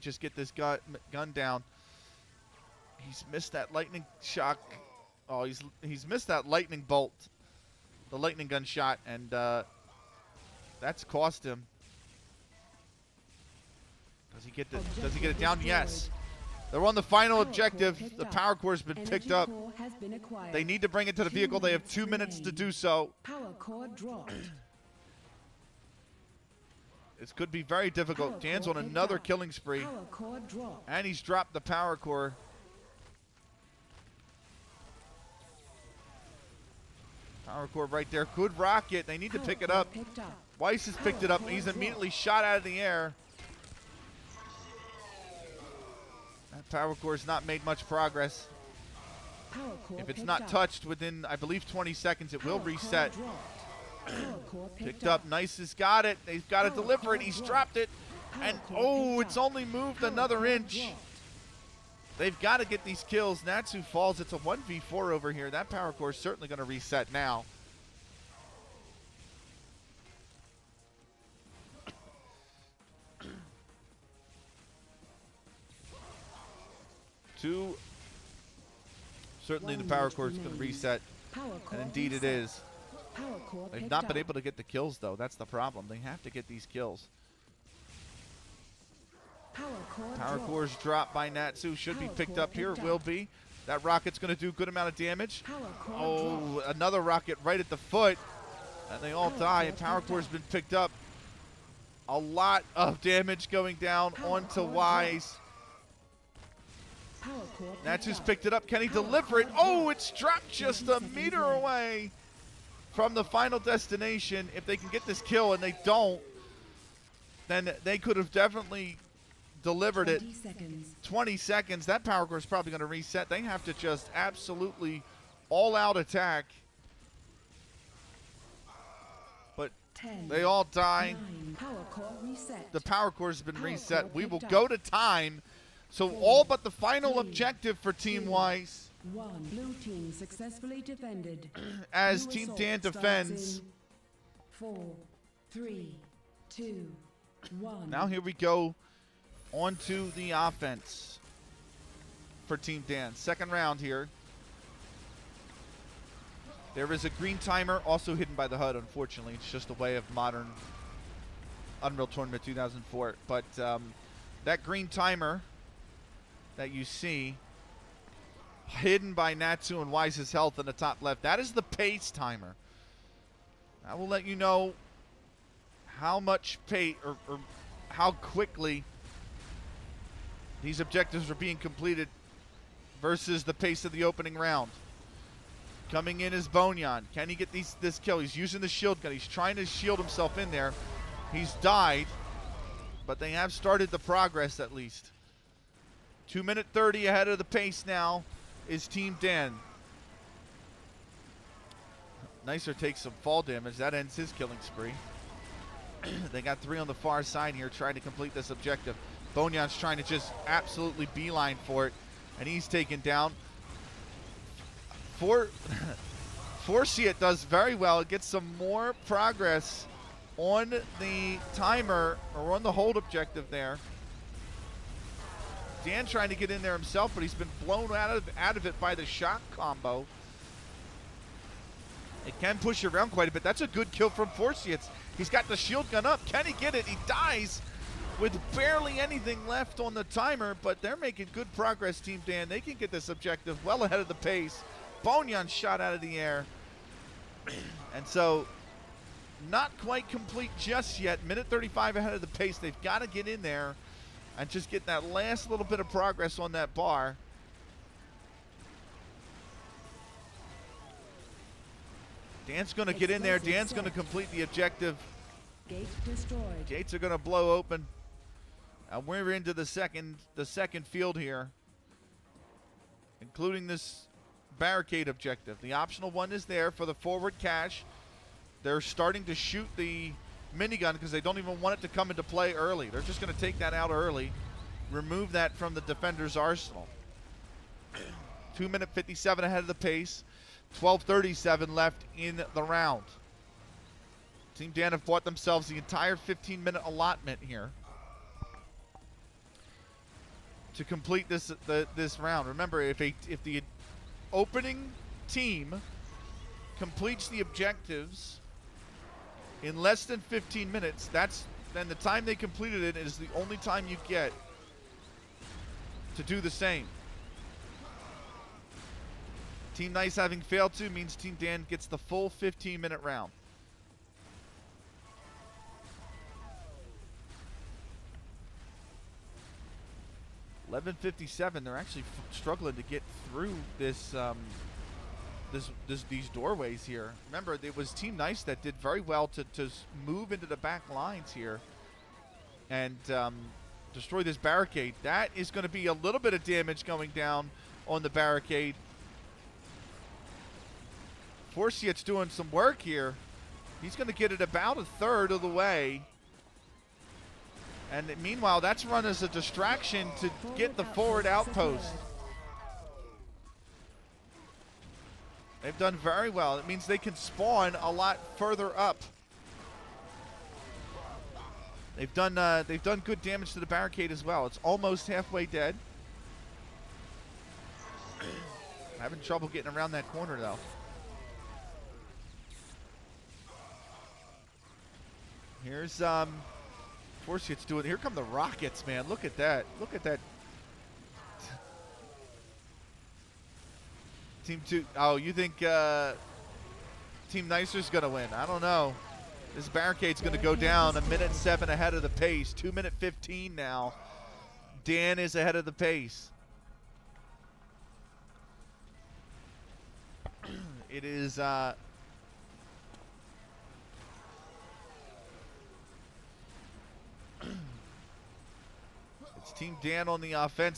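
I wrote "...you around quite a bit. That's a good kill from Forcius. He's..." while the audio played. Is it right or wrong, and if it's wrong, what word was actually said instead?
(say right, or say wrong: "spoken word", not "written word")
right.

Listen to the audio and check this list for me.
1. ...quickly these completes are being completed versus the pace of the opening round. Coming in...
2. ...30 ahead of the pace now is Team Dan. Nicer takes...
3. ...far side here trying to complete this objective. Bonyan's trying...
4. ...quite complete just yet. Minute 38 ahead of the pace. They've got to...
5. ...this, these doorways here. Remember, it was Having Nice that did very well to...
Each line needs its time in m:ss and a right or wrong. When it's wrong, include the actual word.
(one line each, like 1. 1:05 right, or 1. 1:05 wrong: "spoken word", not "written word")
1. 2:58 wrong: "objectives", not "completes"
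2. 3:16 right
3. 3:26 right
4. 4:09 wrong: "35", not "38"
5. 5:35 wrong: "Team", not "Having".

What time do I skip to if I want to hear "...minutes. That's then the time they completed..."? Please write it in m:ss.
5:10.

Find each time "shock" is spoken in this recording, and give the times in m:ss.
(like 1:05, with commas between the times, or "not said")
0:04, 3:49.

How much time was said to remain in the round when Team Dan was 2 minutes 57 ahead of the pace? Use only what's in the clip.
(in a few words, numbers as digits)
12.37.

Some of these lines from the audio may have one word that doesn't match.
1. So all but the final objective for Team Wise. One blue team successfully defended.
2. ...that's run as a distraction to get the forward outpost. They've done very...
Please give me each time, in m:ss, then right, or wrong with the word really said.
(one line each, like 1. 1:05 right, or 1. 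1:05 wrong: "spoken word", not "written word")
1. 2:15 right
2. 5:58 right.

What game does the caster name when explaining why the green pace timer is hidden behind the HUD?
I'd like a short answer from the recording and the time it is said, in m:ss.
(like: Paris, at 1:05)
Unreal Tournament 2004, at 2:41.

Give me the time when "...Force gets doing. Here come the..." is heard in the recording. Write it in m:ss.
6:27.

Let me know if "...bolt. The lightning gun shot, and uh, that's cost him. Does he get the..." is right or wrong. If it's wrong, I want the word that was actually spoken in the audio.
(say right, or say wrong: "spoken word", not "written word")
right.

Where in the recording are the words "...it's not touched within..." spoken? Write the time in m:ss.
0:50.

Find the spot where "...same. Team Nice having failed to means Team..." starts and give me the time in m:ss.
5:16.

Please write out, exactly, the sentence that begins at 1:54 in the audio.
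If they can get this kill and they don't, then they could have definitely delivered 20 it.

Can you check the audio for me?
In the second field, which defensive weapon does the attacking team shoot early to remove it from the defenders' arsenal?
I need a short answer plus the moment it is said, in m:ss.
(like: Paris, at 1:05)
Minigun, at 4:40.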